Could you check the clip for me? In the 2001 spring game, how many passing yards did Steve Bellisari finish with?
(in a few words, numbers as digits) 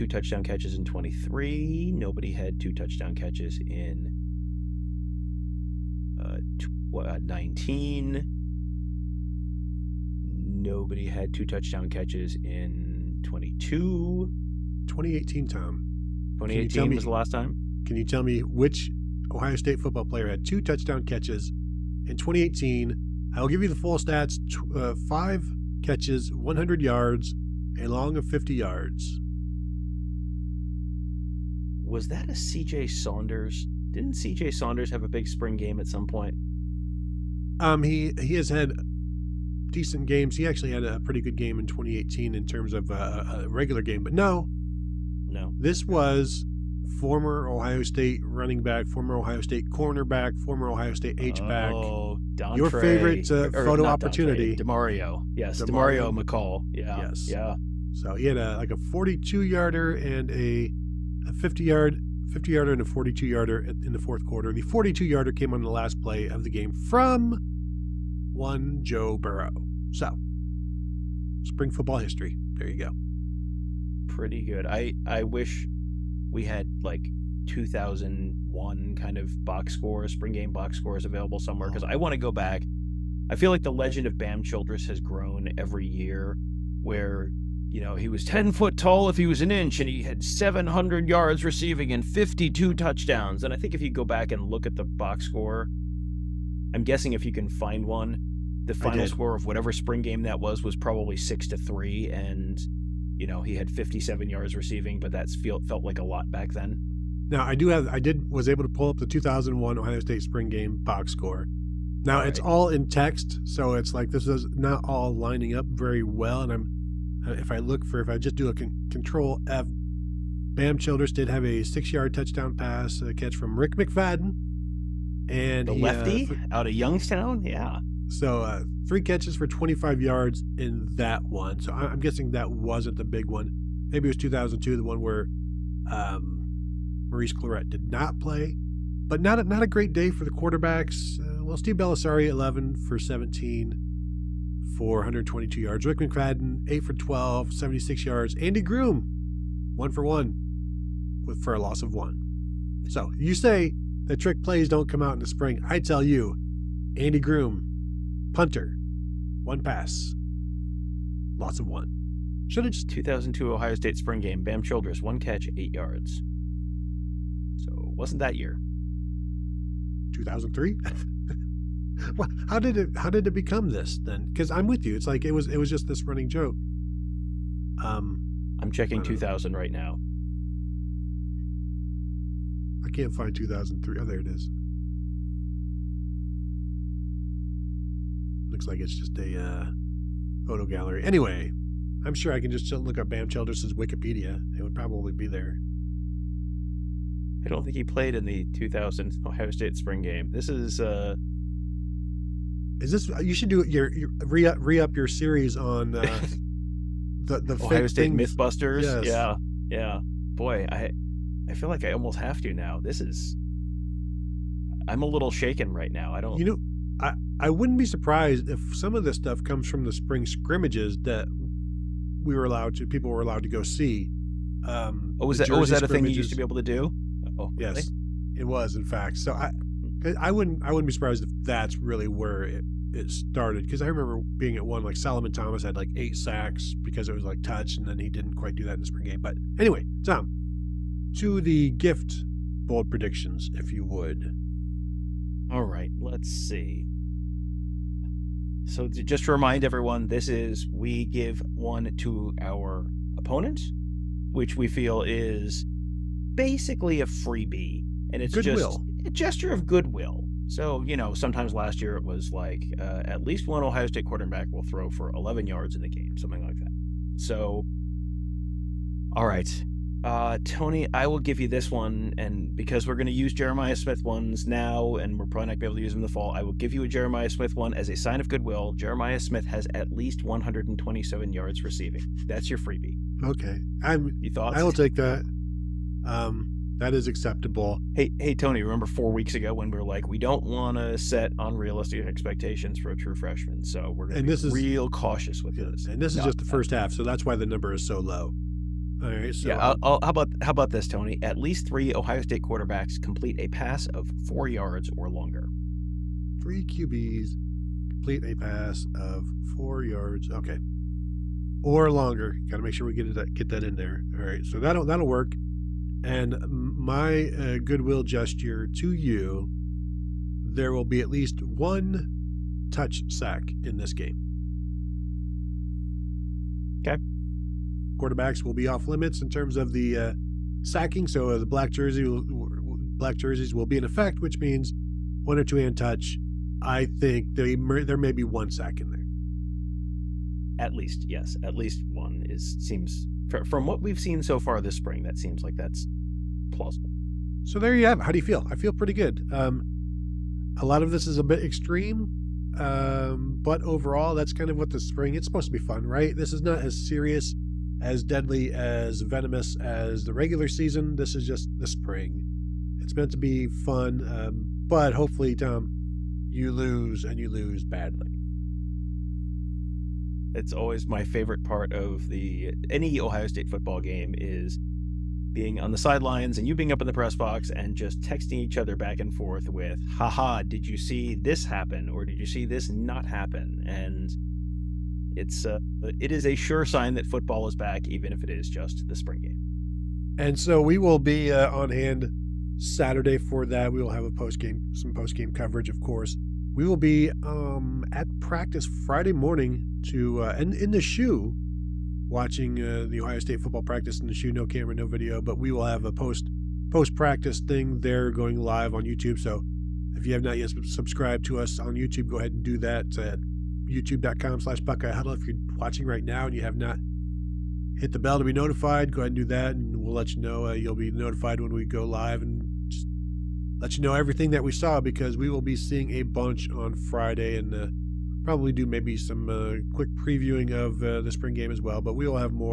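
122.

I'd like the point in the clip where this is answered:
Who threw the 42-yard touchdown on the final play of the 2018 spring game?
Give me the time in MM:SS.
01:08.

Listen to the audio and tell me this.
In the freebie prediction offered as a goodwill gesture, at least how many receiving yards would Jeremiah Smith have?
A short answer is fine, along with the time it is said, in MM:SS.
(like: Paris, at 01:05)
127, at 04:40.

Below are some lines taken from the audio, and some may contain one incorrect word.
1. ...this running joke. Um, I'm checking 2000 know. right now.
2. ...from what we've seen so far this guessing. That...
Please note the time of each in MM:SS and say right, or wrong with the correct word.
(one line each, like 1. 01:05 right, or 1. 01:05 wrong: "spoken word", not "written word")
1. 02:55 right
2. 05:43 wrong: "spring", not "guessing".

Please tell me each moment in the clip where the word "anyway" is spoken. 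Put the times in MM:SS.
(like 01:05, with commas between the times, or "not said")
03:11, 03:59.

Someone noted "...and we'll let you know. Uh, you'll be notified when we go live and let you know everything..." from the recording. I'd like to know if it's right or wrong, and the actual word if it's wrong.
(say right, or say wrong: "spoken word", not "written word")
right.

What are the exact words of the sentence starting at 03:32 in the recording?
This is I'm a little shaken right now.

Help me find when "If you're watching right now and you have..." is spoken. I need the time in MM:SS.
06:55.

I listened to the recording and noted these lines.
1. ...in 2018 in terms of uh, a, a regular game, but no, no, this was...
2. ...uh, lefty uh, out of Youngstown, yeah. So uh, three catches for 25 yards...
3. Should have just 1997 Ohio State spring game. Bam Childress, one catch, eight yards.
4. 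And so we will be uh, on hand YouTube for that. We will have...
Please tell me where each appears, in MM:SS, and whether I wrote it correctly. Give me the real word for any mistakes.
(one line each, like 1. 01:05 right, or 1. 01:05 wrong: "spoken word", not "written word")
1. 00:41 right
2. 02:05 right
3. 02:42 wrong: "2002", not "1997"
4. 06:30 wrong: "Saturday", not "YouTube".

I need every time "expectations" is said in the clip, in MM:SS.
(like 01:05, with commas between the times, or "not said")
04:52.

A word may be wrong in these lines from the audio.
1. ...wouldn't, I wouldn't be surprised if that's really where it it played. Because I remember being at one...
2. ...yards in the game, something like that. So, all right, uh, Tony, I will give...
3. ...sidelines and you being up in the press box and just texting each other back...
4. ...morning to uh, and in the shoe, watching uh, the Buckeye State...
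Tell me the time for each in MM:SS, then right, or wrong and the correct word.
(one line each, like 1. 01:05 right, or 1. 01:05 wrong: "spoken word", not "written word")
1. 03:50 wrong: "started", not "played"
2. 04:25 right
3. 06:15 right
4. 06:39 wrong: "Ohio", not "Buckeye".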